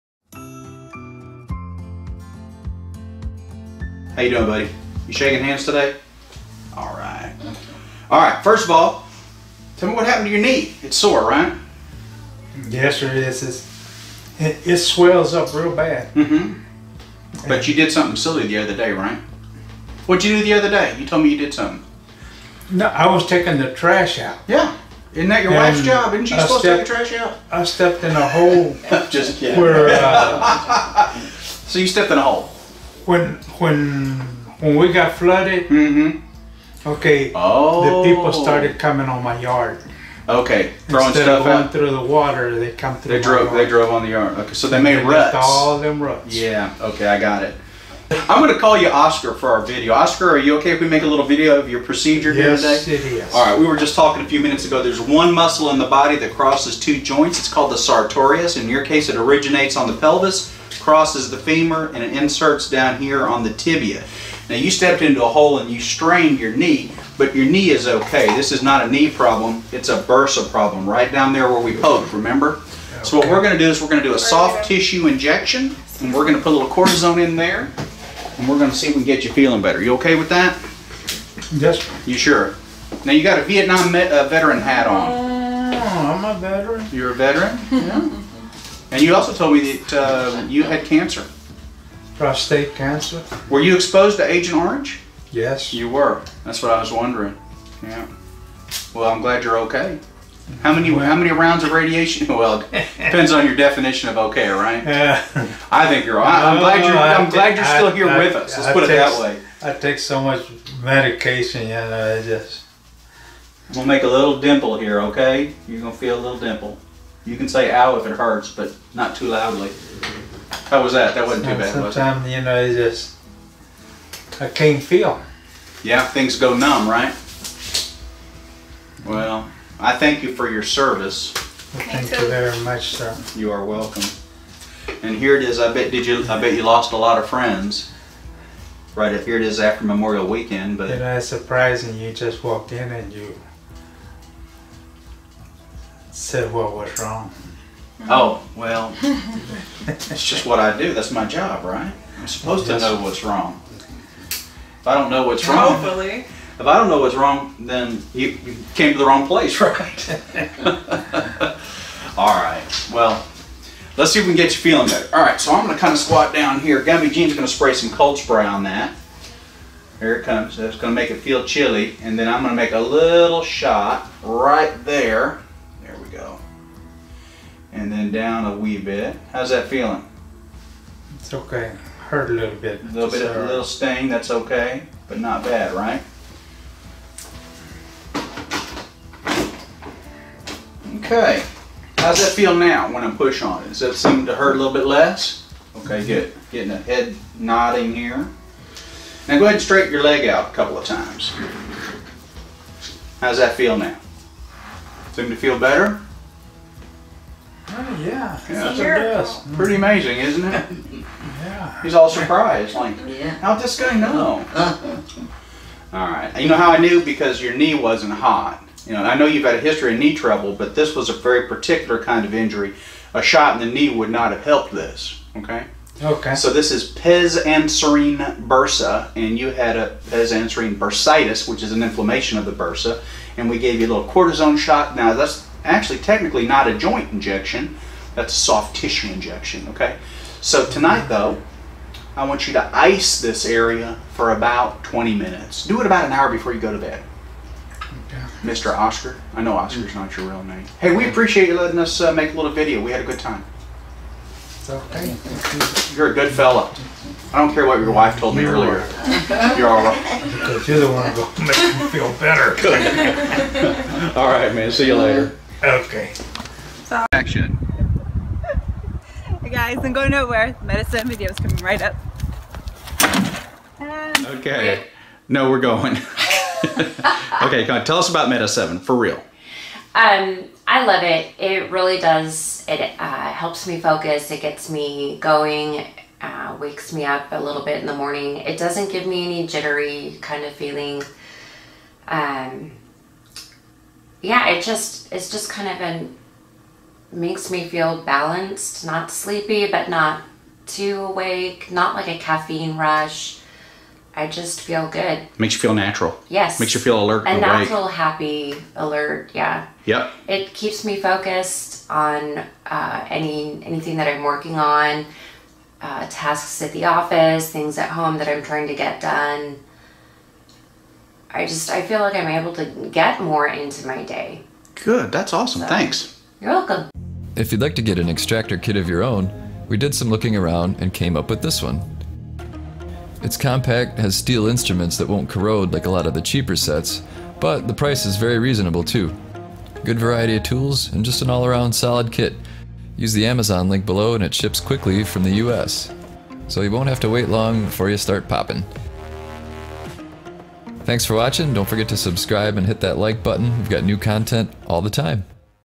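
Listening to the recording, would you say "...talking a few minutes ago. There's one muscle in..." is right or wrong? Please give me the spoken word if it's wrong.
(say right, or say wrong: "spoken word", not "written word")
right.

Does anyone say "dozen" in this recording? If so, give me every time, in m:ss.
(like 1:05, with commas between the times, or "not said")
not said.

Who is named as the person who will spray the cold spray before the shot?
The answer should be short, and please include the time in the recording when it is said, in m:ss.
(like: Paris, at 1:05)
Gummy Jean, at 2:46.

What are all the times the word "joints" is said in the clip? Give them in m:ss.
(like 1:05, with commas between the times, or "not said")
0:57, 3:56.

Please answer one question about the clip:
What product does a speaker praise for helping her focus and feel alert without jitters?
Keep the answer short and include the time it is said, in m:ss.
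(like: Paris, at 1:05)
Meta 7, at 4:38.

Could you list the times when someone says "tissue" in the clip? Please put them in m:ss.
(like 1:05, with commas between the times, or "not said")
1:14, 3:58.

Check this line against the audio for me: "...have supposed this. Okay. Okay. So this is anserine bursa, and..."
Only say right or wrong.
wrong.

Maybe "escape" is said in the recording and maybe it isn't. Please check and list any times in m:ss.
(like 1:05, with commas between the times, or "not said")
not said.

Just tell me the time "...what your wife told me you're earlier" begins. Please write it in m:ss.
4:17.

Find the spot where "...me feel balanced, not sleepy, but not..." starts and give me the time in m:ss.
4:57.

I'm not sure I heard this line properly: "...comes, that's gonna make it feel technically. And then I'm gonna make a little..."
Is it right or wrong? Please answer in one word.
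wrong.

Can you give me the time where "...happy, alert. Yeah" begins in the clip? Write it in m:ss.
5:07.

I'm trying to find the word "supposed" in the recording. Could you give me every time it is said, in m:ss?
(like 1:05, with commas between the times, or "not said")
0:26, 2:32.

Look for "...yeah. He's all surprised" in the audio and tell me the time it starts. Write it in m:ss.
3:31.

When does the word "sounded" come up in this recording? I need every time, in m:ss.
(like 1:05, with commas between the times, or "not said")
not said.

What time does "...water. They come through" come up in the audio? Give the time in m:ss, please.
0:42.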